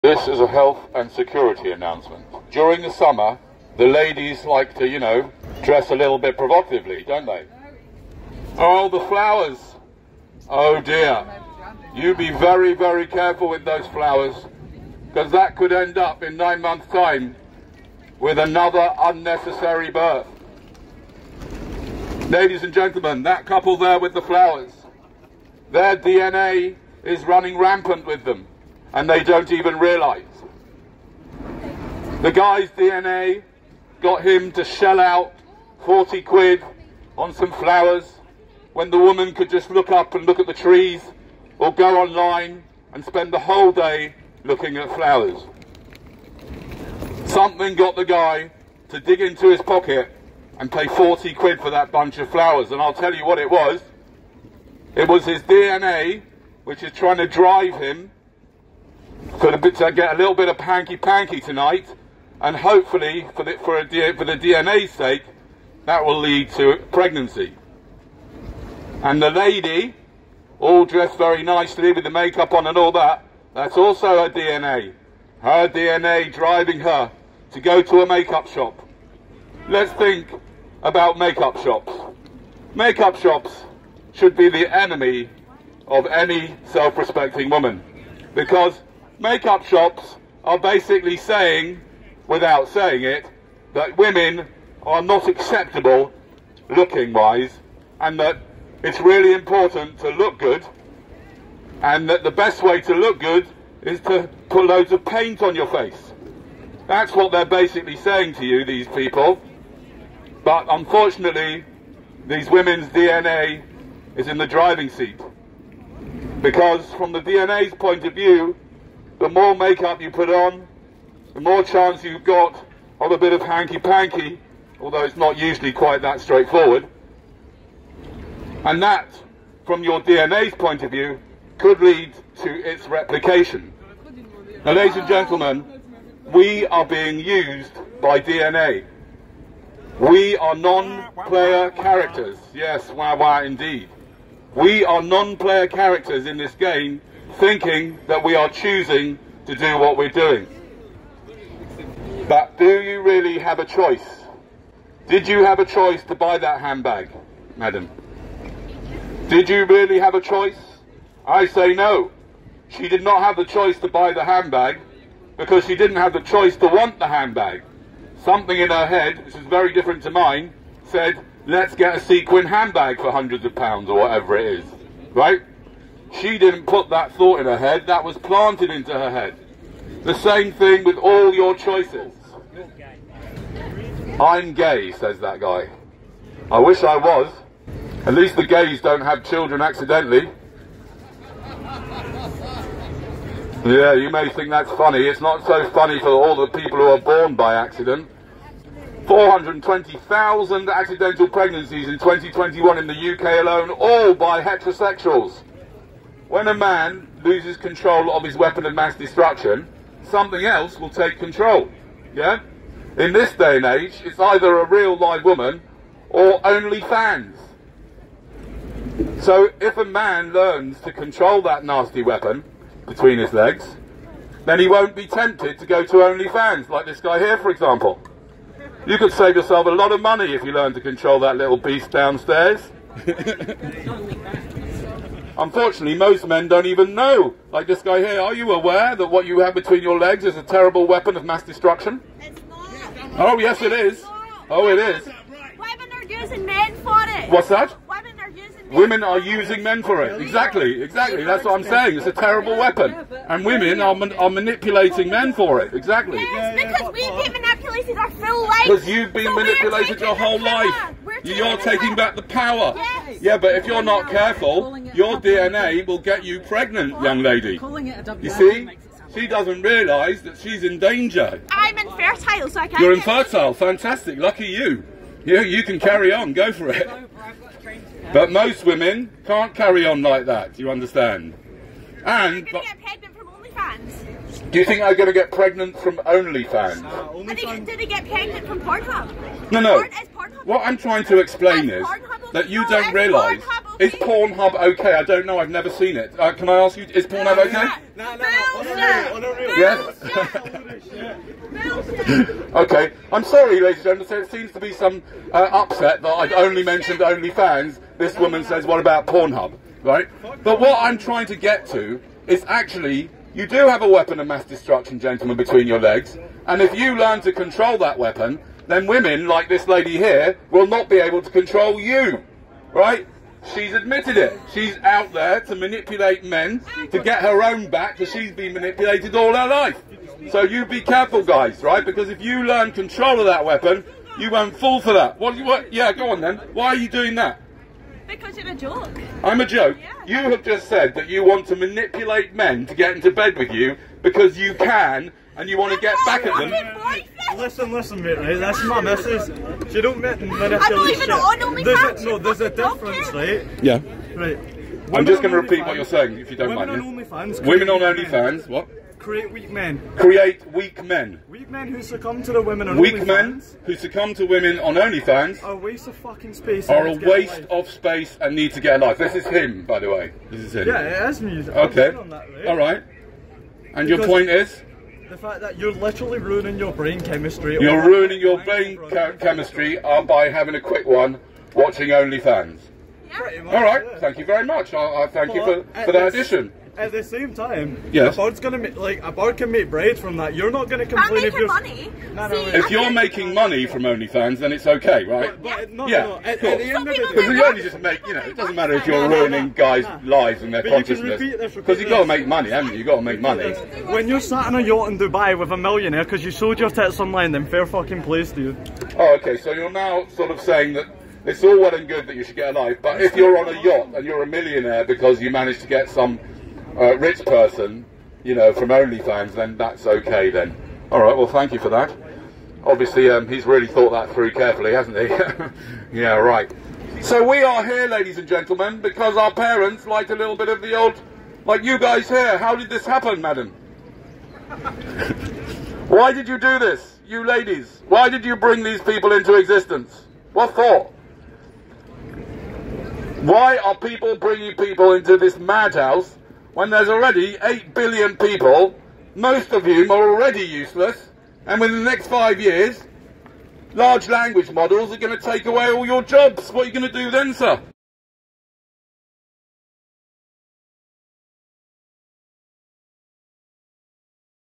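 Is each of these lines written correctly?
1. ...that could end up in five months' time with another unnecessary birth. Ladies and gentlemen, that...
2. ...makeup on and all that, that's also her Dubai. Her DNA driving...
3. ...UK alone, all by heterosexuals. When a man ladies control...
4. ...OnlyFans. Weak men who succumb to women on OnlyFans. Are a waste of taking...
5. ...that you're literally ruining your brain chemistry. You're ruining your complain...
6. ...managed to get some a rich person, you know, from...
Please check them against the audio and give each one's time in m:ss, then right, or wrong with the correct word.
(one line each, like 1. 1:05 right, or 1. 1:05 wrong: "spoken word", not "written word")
1. 0:15 wrong: "nine", not "five"
2. 1:12 wrong: "DNA", not "Dubai"
3. 3:23 wrong: "loses", not "ladies"
4. 6:02 wrong: "fucking", not "taking"
5. 6:15 wrong: "brain", not "complain"
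6. 6:55 right.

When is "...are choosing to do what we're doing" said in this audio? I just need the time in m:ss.
2:28.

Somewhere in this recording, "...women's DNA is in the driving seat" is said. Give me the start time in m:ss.
1:52.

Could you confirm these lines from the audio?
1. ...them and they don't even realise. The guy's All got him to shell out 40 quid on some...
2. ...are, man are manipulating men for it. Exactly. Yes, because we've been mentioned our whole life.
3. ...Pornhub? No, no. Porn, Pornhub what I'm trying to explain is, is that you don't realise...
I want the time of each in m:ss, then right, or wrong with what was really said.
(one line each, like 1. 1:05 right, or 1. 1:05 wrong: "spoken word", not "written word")
1. 0:28 wrong: "DNA", not "All"
2. 4:13 wrong: "manipulated", not "mentioned"
3. 4:48 right.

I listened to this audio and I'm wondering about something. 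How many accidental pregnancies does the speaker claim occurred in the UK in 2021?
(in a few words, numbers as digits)
420,000.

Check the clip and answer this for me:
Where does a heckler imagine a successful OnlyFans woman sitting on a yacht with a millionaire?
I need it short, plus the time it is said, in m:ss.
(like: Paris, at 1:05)
Dubai, at 6:44.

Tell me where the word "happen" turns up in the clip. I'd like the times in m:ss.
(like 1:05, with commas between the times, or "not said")
7:12.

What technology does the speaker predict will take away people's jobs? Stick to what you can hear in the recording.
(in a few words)
large language models.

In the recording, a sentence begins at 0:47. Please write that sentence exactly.
Something got the guy to dig into his pocket and pay 40 quid for that bunch of flowers.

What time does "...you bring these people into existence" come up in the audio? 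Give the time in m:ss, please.
7:18.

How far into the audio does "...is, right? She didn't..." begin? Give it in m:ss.
2:54.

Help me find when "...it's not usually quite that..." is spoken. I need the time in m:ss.
2:05.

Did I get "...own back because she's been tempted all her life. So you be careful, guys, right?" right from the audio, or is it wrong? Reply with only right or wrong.
wrong.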